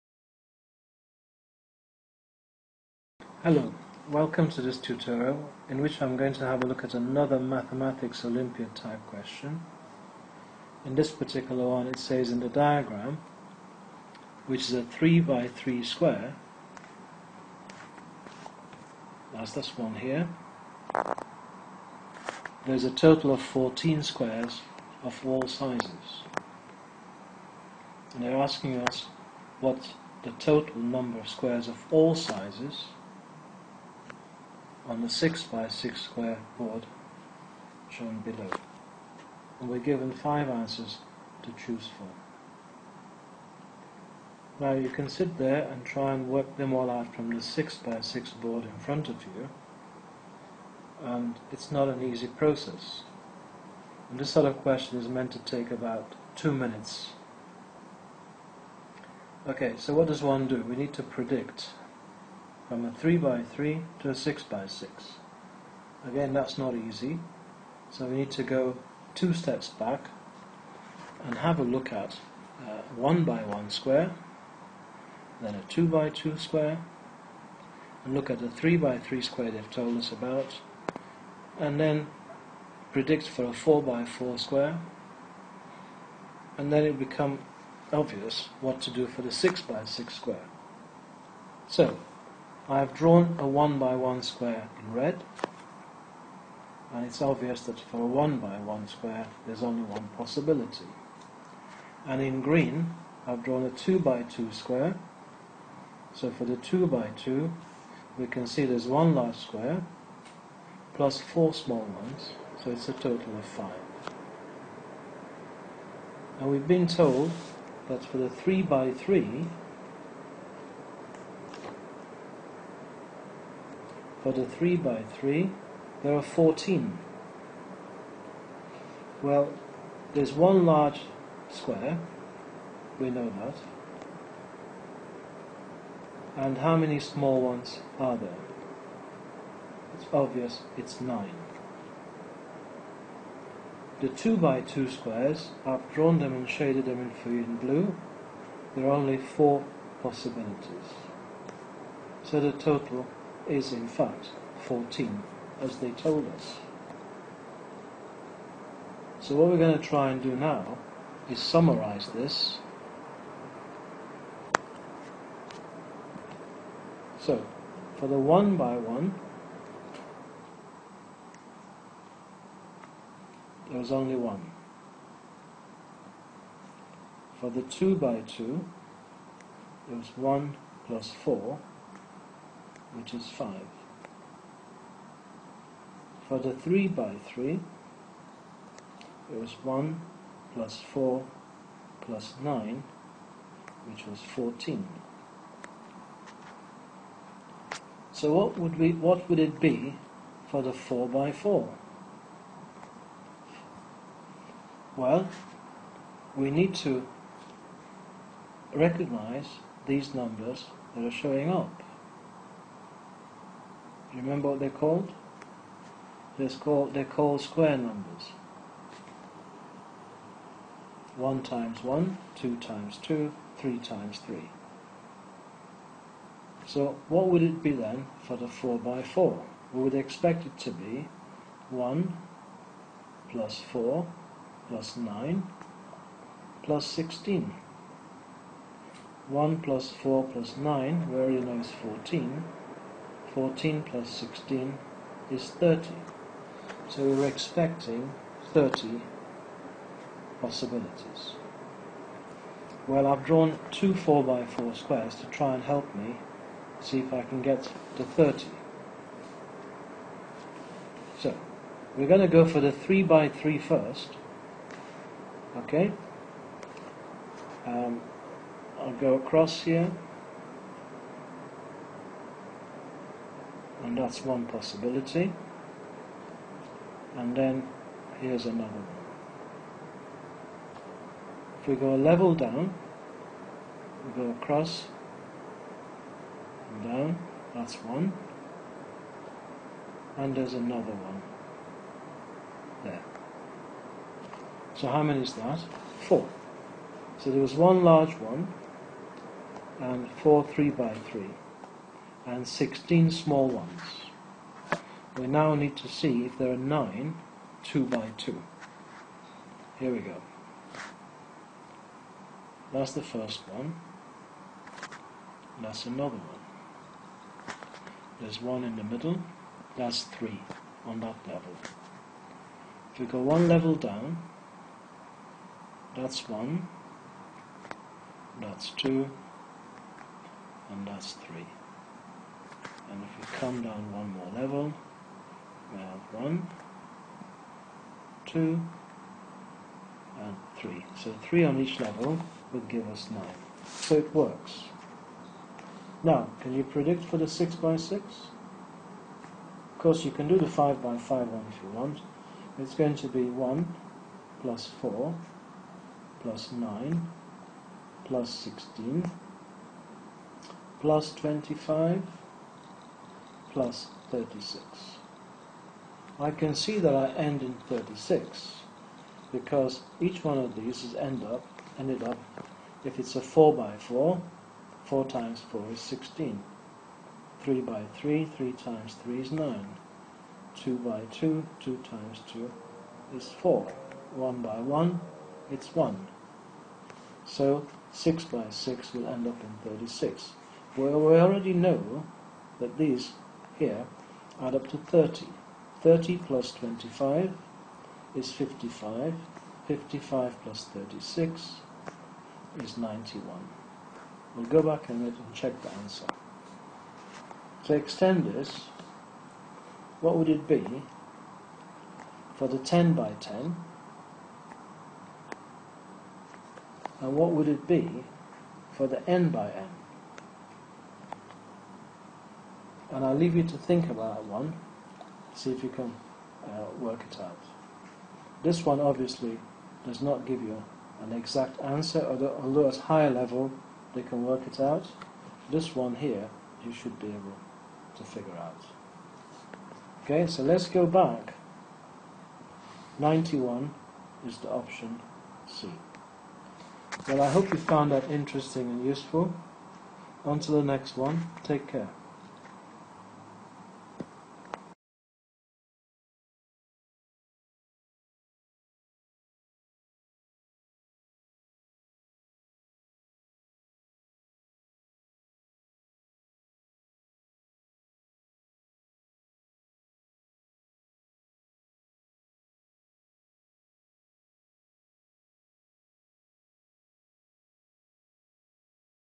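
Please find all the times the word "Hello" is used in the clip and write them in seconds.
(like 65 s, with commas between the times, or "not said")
3 s.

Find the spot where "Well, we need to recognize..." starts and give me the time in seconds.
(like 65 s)
204 s.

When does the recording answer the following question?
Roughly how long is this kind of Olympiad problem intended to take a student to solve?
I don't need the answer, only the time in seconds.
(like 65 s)
55 s.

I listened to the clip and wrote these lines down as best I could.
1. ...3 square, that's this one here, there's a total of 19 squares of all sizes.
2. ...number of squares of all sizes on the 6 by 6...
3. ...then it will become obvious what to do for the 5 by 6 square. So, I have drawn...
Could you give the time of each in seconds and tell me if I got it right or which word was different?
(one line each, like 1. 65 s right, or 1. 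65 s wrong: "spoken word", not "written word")
1. 15 s wrong: "14", not "19"
2. 30 s right
3. 86 s wrong: "6", not "5".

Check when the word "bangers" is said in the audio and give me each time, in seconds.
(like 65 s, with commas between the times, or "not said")
not said.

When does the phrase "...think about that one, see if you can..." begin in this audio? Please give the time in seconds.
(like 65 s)
423 s.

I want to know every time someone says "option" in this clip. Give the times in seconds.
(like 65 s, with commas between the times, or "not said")
444 s.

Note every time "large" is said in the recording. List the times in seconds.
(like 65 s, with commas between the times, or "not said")
109 s, 130 s, 297 s.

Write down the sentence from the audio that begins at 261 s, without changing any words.
So, we're going to go for the 3x3 first.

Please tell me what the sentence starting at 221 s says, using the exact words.
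1 times 1, 2 times 2, 3 times 3.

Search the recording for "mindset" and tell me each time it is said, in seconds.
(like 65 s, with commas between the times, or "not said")
not said.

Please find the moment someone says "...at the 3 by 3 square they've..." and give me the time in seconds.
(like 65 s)
78 s.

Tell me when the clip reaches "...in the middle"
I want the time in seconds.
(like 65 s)
318 s.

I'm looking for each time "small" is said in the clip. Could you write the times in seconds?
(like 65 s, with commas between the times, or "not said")
111 s, 136 s, 303 s.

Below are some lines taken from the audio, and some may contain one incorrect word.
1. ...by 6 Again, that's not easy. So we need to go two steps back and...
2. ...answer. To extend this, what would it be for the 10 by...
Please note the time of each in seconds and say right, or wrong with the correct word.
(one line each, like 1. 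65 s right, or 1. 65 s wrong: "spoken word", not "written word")
1. 64 s right
2. 405 s right.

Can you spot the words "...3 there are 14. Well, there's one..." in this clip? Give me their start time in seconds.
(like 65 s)
125 s.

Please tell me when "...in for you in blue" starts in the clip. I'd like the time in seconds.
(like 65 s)
147 s.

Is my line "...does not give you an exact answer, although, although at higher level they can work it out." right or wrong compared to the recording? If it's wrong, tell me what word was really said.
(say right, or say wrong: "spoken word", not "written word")
right.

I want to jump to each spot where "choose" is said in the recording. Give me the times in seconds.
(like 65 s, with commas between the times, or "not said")
41 s.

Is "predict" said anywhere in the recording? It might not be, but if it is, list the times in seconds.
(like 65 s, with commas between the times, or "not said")
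61 s, 82 s, 346 s.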